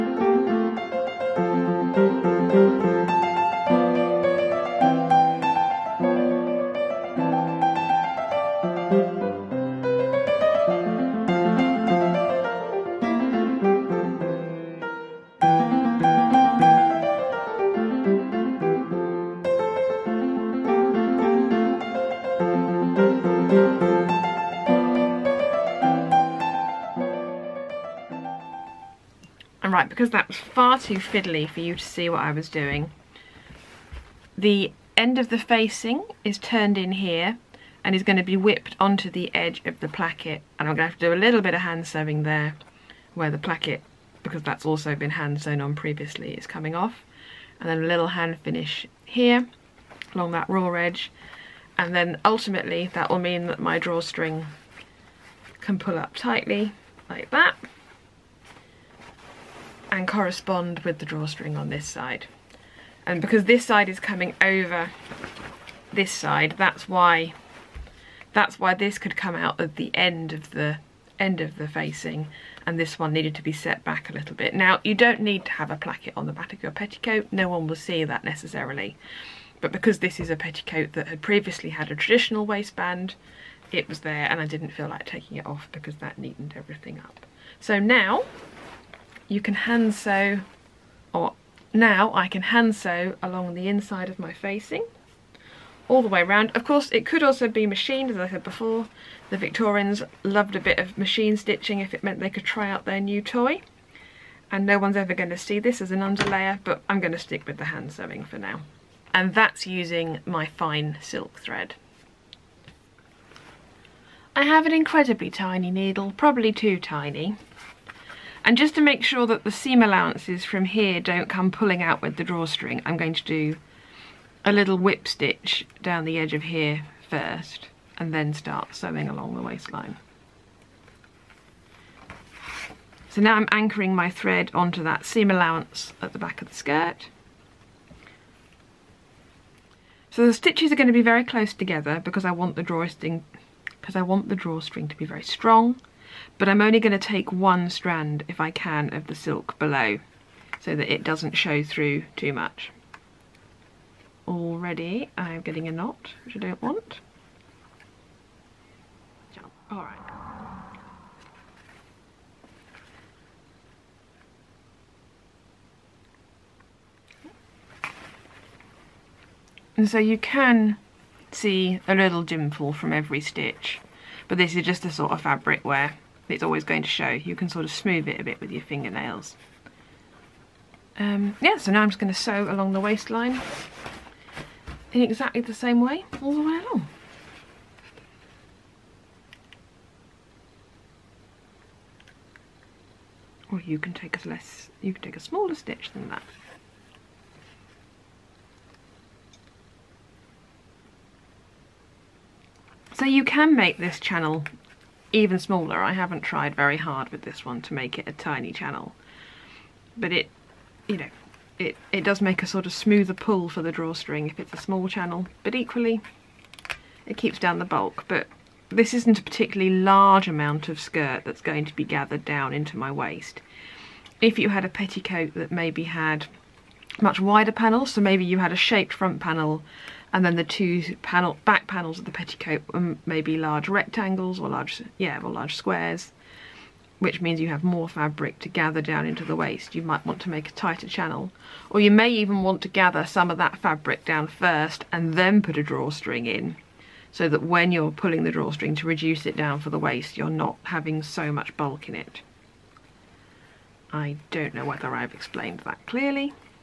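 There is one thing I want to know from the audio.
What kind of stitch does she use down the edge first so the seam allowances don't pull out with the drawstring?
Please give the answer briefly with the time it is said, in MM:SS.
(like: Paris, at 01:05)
whip stitch, at 02:04.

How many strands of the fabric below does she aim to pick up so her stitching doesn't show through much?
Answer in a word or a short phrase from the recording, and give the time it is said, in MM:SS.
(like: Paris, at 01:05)
1, at 02:27.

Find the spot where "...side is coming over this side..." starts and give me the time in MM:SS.
01:03.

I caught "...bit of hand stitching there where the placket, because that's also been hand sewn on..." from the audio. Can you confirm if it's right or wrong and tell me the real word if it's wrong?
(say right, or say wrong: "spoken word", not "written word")
wrong: "sewing", not "stitching".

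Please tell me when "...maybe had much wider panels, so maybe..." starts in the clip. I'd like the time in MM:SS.
03:45.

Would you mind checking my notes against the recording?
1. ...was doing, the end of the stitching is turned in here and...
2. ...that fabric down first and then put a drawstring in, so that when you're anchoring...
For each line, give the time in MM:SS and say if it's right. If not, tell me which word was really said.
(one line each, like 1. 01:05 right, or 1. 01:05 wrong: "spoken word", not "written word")
1. 00:32 wrong: "facing", not "stitching"
2. 04:03 wrong: "pulling", not "anchoring".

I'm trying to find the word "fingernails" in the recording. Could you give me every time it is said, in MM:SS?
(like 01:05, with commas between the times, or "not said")
02:58.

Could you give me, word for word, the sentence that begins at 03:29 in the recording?
But it, you know, it, it does make a sort of smoother pull for the drawstring if it's a small channel.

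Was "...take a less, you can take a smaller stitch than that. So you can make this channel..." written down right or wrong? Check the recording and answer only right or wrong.
right.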